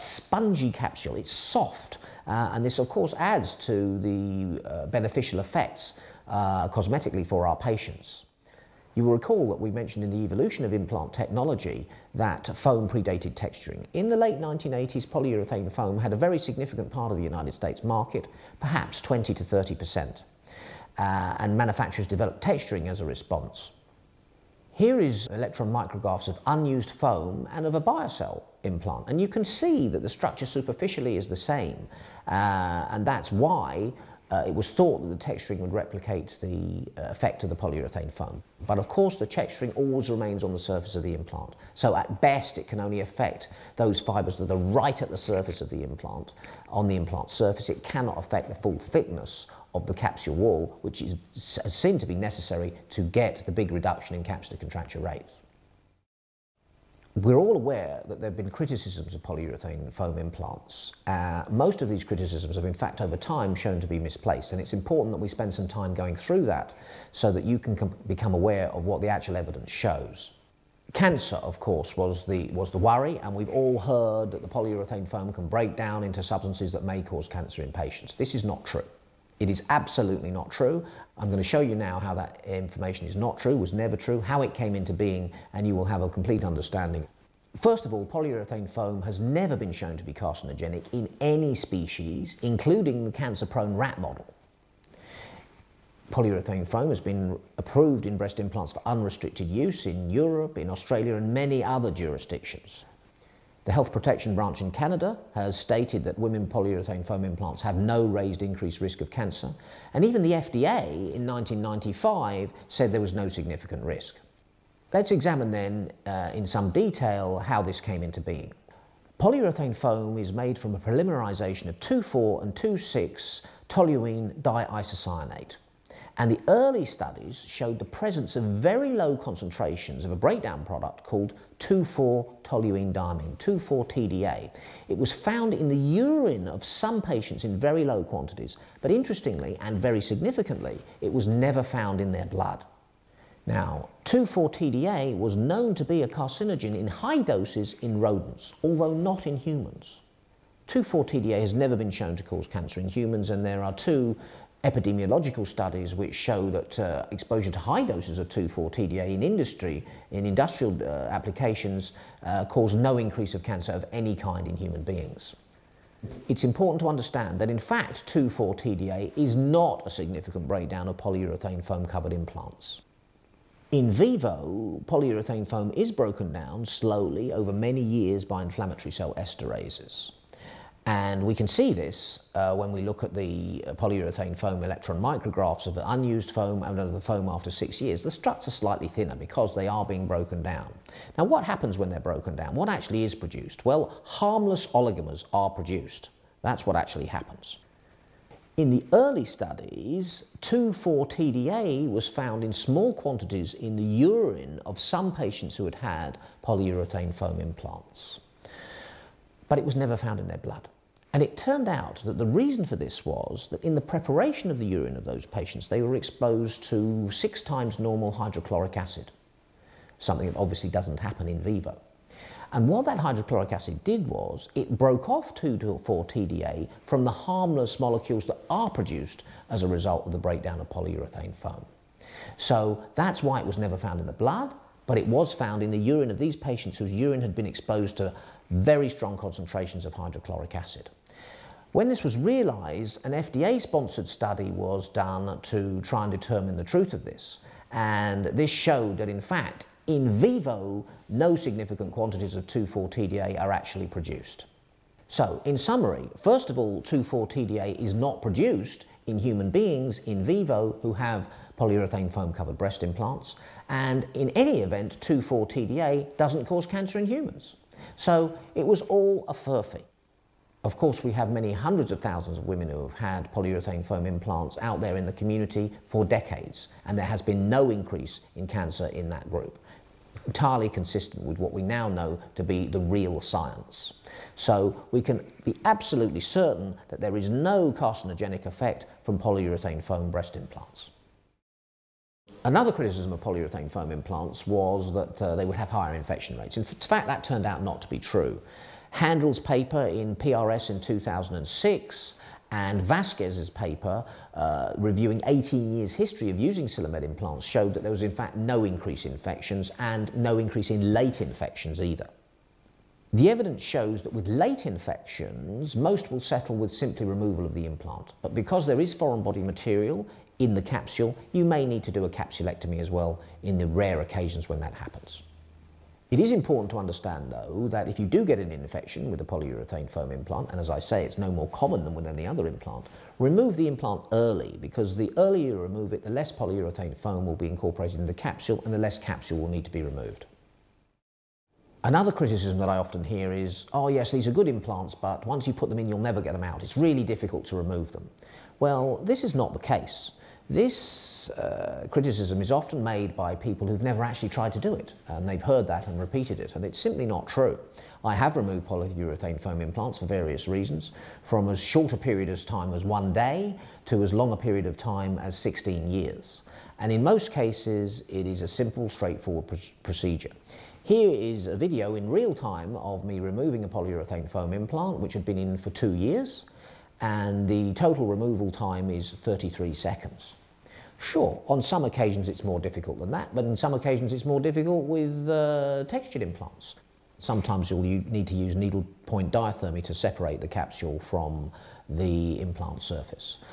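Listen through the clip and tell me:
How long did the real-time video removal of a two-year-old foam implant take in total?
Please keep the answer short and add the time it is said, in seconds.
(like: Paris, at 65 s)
33 seconds, at 379 s.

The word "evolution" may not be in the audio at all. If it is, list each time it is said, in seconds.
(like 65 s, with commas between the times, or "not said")
10 s.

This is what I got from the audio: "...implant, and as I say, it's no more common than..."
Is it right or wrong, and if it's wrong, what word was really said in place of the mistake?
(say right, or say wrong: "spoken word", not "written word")
right.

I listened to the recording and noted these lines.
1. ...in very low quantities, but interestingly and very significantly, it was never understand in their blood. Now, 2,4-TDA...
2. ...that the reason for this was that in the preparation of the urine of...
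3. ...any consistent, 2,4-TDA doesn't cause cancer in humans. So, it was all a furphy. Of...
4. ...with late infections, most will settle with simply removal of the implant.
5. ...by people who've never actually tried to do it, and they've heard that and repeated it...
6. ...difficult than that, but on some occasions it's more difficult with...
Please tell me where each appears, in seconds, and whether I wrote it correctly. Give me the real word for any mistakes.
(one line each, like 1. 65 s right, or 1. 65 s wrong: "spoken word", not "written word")
1. 137 s wrong: "found", not "understand"
2. 212 s right
3. 264 s wrong: "event", not "consistent"
4. 314 s right
5. 353 s right
6. 382 s right.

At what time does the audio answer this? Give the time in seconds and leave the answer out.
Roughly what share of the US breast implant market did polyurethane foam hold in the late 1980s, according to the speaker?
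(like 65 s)
19 s.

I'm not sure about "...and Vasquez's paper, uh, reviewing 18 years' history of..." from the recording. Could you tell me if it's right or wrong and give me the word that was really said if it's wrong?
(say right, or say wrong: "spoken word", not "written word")
right.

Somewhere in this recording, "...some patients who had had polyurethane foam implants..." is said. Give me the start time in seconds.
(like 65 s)
204 s.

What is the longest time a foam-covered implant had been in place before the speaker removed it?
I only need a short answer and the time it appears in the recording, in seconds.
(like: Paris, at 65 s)
16 years, at 365 s.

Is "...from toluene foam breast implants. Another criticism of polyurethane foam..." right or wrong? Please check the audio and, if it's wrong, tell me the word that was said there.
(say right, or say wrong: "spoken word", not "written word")
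wrong: "polyurethane", not "toluene".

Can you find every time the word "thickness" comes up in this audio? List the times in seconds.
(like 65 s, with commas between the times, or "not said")
48 s.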